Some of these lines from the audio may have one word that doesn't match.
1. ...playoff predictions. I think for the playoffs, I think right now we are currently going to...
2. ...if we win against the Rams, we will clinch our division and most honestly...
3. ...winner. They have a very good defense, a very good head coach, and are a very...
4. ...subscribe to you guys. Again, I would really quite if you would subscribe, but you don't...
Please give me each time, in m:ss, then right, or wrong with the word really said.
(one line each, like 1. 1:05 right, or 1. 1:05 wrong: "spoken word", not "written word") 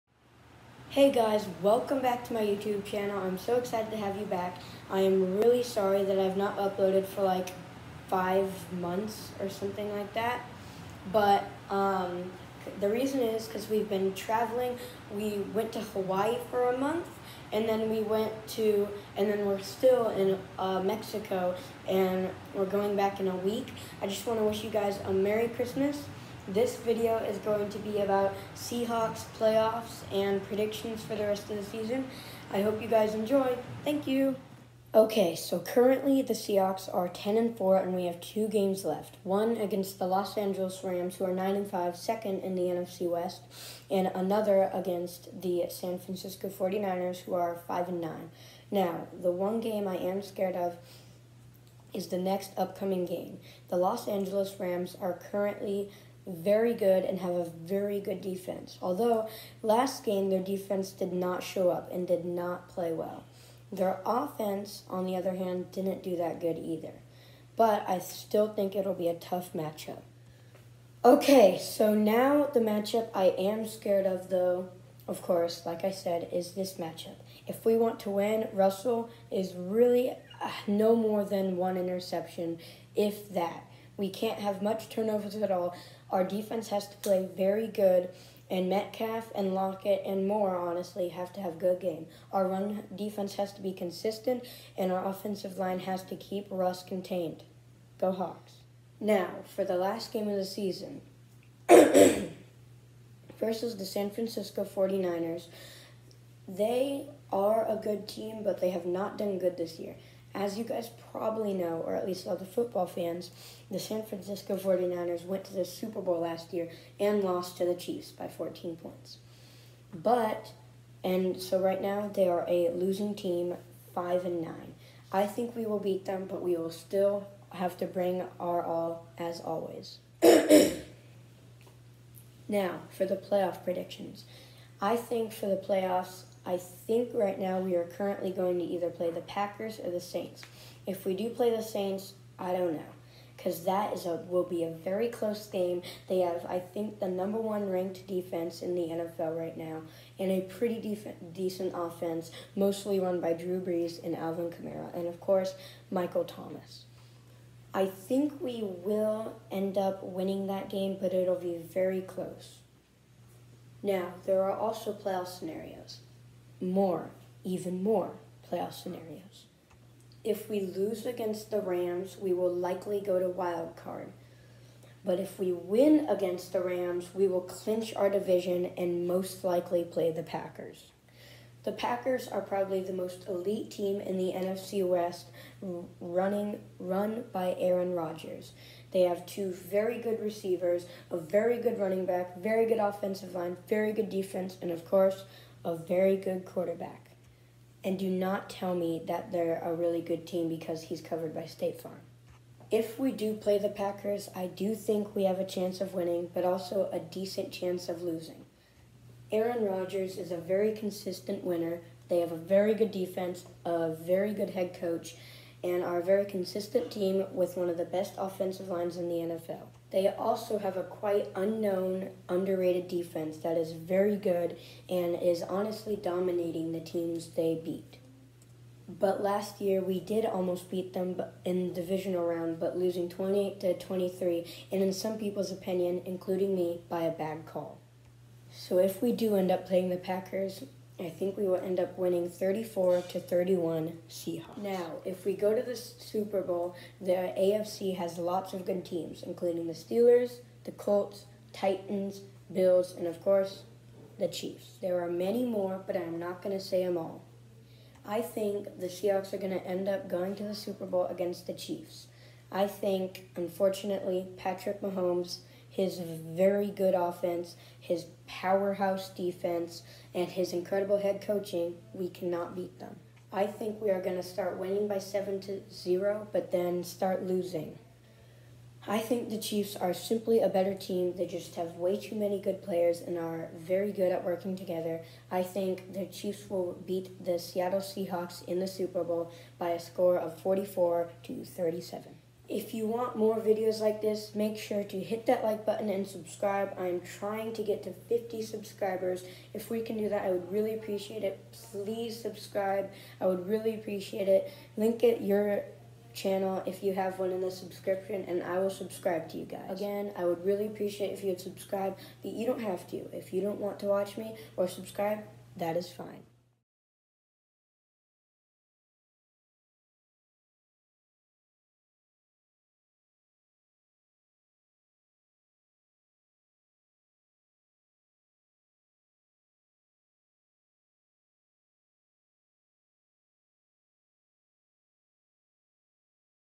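1. 2:13 right
2. 2:55 wrong: "likely", not "honestly"
3. 3:31 right
4. 5:08 wrong: "appreciate", not "quite".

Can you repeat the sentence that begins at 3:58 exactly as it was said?
So if we do end up playing the Packers, I think we will end up winning 34 to 31 Seahawks.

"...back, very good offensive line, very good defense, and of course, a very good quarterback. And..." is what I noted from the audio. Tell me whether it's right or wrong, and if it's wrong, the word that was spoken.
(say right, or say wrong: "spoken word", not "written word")
right.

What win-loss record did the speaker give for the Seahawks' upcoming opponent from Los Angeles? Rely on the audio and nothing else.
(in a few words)
9 and 5.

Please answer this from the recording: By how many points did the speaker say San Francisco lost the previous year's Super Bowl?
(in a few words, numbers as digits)
14.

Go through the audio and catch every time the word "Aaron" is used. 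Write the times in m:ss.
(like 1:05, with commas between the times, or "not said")
3:07, 3:29.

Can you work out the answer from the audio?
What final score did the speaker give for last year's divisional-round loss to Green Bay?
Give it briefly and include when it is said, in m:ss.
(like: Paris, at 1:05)
28 to 23, at 3:53.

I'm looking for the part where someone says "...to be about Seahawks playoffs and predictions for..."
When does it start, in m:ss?
0:27.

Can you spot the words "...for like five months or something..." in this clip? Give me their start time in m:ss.
0:07.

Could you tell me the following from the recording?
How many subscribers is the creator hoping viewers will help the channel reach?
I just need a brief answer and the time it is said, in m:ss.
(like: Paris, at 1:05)
50, at 4:58.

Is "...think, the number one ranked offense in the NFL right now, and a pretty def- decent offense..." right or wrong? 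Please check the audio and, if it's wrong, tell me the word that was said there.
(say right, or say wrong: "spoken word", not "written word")
wrong: "defense", not "offense".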